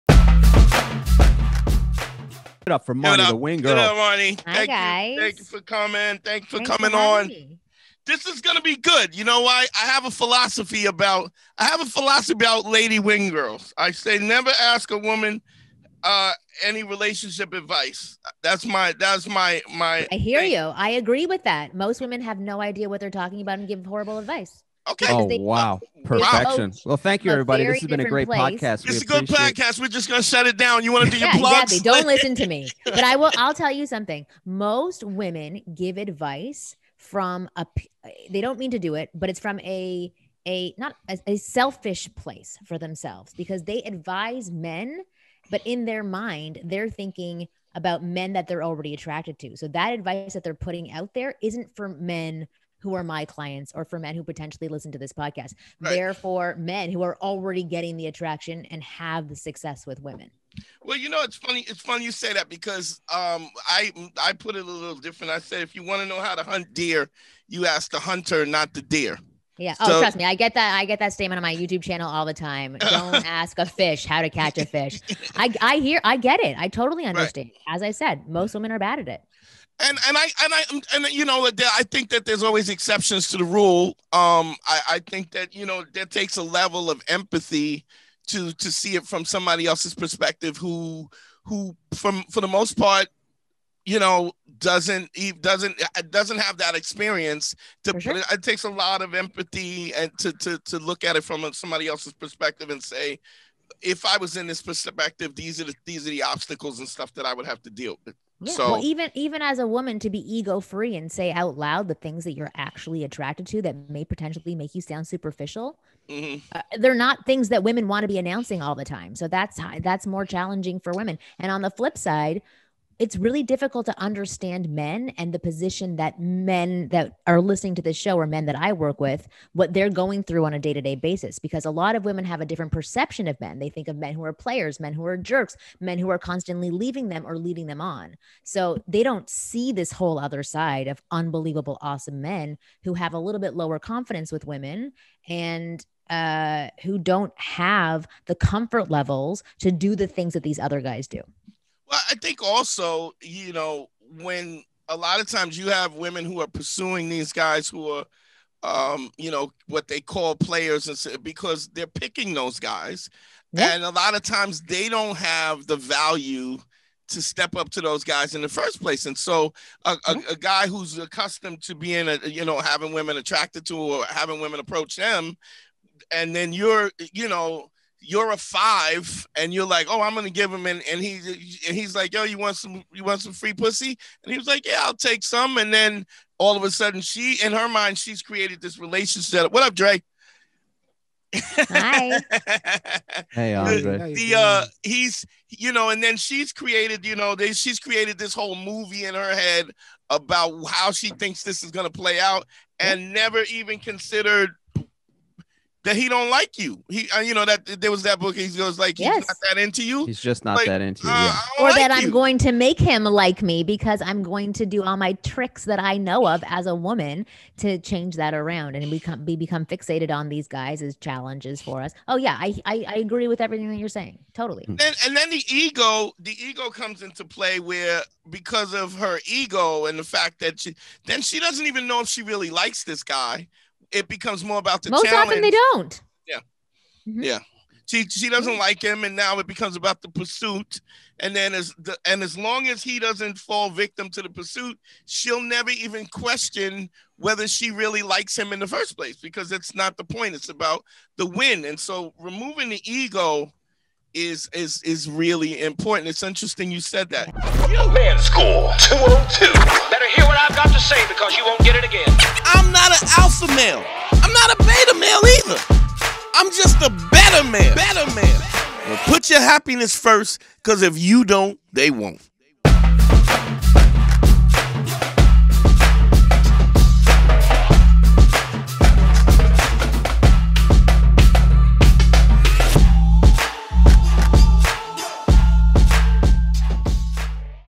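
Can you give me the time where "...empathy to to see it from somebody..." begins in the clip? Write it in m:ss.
1:27.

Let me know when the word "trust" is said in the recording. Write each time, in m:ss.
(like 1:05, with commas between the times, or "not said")
1:09.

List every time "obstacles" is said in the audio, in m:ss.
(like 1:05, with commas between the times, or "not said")
1:46.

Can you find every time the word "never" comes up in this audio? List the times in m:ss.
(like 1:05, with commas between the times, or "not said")
0:14, 3:23, 4:05.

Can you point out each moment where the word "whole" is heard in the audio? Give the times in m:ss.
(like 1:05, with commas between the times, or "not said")
2:19, 3:18.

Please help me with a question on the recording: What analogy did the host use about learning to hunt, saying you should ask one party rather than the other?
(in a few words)
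ask the hunter.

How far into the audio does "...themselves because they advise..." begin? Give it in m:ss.
0:42.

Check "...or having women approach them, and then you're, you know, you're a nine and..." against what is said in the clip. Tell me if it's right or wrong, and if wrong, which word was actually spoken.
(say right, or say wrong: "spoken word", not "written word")
wrong: "five", not "nine".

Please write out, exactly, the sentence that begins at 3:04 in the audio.
And he was like, yeah, I'll take some.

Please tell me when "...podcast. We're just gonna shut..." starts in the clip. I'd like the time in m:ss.
0:29.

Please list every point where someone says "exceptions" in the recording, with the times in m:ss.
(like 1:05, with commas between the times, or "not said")
1:22.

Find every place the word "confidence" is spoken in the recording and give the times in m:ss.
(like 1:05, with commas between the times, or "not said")
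2:23.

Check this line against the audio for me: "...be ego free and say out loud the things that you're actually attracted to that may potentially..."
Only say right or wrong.
right.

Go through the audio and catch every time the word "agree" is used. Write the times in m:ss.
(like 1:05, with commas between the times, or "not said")
0:20, 3:42.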